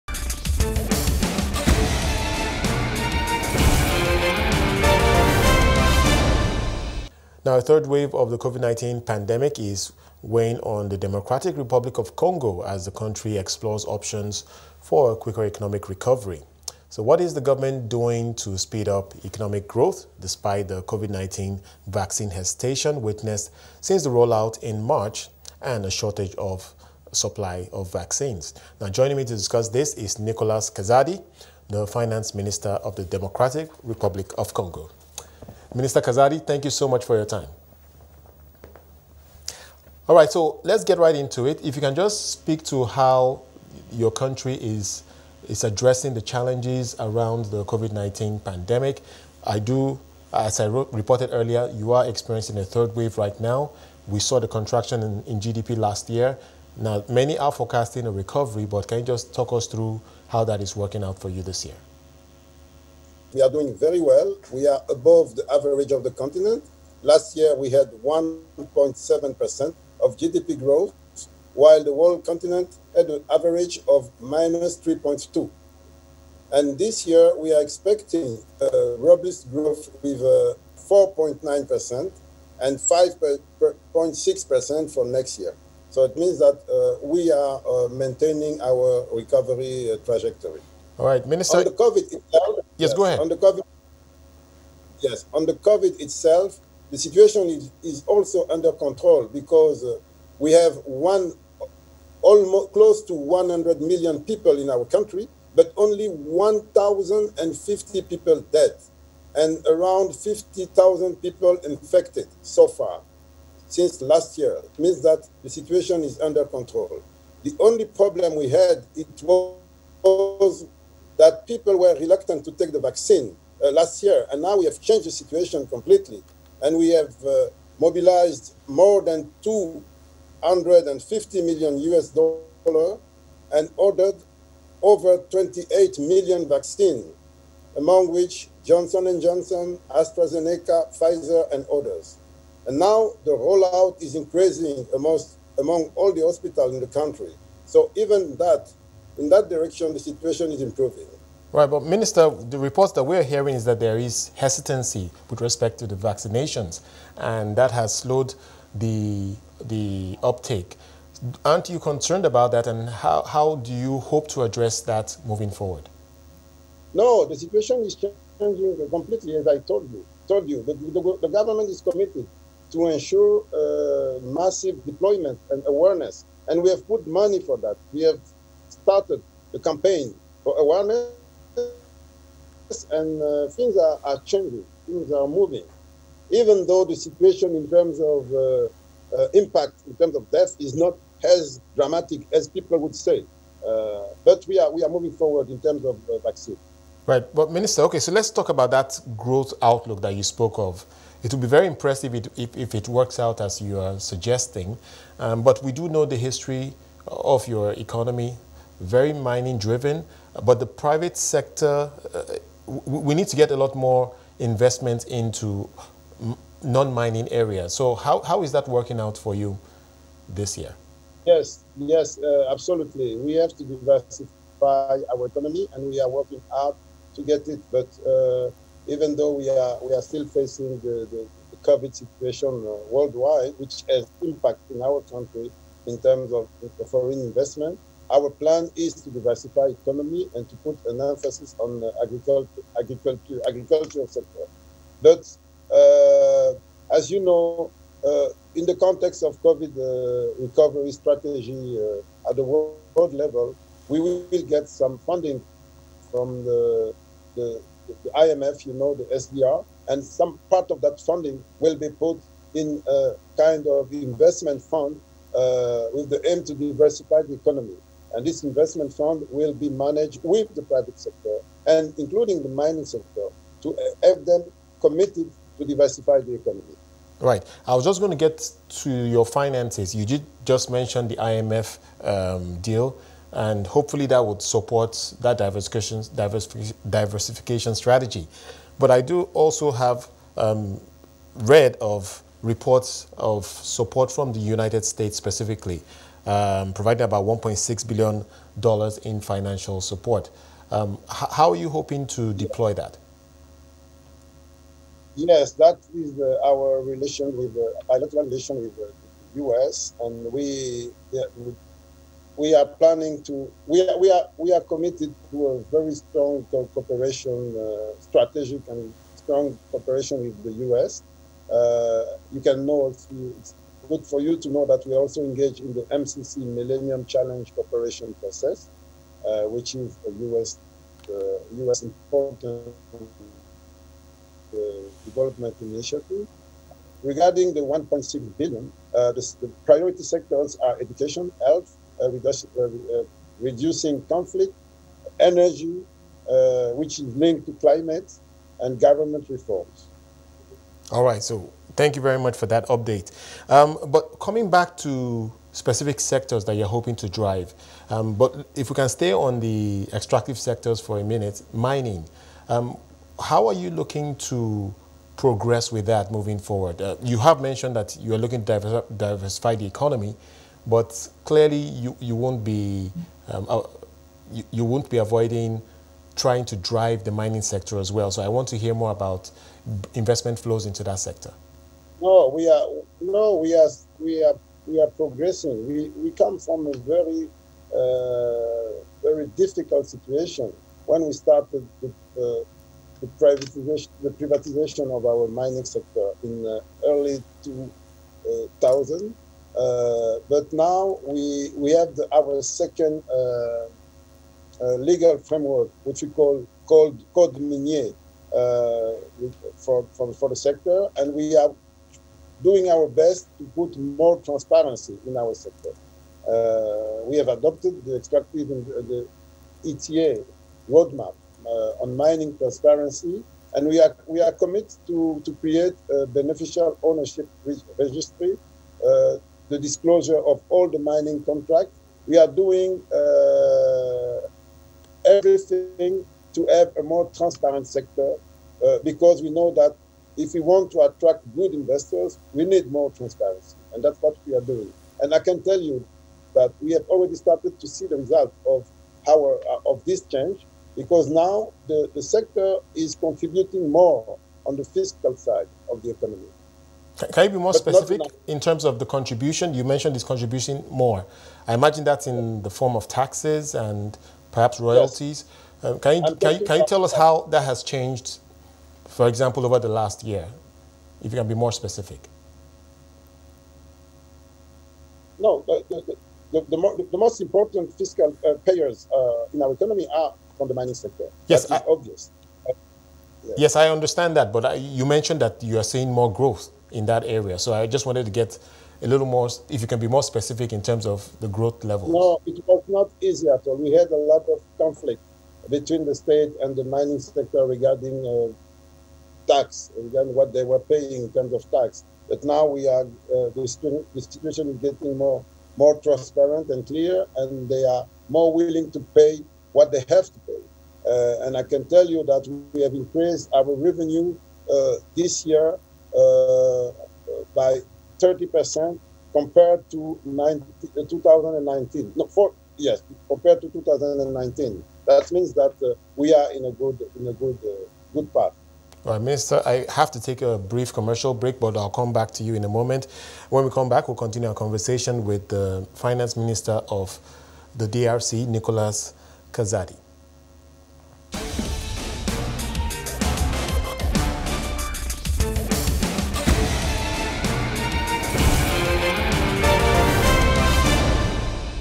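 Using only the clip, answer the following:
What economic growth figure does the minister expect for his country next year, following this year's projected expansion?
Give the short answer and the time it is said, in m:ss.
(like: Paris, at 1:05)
5.6%, at 1:22.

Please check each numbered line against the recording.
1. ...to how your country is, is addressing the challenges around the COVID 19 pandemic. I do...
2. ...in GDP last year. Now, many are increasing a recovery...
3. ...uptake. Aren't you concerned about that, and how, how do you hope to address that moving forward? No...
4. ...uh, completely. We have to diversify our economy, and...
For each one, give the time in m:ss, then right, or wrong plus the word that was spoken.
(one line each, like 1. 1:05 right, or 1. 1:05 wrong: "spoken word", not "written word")
1. 0:42 right
2. 0:55 wrong: "forecasting", not "increasing"
3. 2:40 right
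4. 3:42 wrong: "absolutely", not "completely".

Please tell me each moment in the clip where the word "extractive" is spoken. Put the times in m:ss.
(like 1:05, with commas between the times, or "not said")
5:59, 6:57.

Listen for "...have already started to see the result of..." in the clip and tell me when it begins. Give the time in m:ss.
7:26.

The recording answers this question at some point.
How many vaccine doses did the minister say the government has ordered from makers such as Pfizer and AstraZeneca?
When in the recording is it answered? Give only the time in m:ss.
2:15.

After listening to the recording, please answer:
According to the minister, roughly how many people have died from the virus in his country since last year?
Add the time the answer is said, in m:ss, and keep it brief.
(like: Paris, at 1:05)
1,050, at 1:46.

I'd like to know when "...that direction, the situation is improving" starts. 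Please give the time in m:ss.
2:29.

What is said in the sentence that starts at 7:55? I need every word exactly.
No, the, the, the, the more, most important fiscal uh, payers uh, in our economy are from the mining sector.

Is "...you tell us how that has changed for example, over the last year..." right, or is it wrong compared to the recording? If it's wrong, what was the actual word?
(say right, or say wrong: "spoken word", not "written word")
right.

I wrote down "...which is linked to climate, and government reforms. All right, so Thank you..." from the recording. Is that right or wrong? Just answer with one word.
right.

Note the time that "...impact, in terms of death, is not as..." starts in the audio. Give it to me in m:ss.
3:09.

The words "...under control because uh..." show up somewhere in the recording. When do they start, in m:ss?
1:38.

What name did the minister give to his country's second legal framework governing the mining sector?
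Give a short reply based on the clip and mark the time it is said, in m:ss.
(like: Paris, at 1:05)
Code Minier, at 6:47.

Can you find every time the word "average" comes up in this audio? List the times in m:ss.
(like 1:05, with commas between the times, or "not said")
1:05, 1:13.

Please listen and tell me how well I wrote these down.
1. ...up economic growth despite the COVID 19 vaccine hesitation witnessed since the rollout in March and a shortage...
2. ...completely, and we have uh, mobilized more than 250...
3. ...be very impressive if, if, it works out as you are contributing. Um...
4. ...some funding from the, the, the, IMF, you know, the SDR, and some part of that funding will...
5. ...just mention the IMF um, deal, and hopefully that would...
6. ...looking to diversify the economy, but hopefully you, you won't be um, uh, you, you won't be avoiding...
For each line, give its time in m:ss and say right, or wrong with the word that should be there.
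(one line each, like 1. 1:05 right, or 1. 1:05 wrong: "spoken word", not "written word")
1. 0:18 right
2. 2:05 right
3. 3:21 wrong: "suggesting", not "contributing"
4. 4:14 right
5. 4:40 right
6. 6:08 wrong: "clearly", not "hopefully".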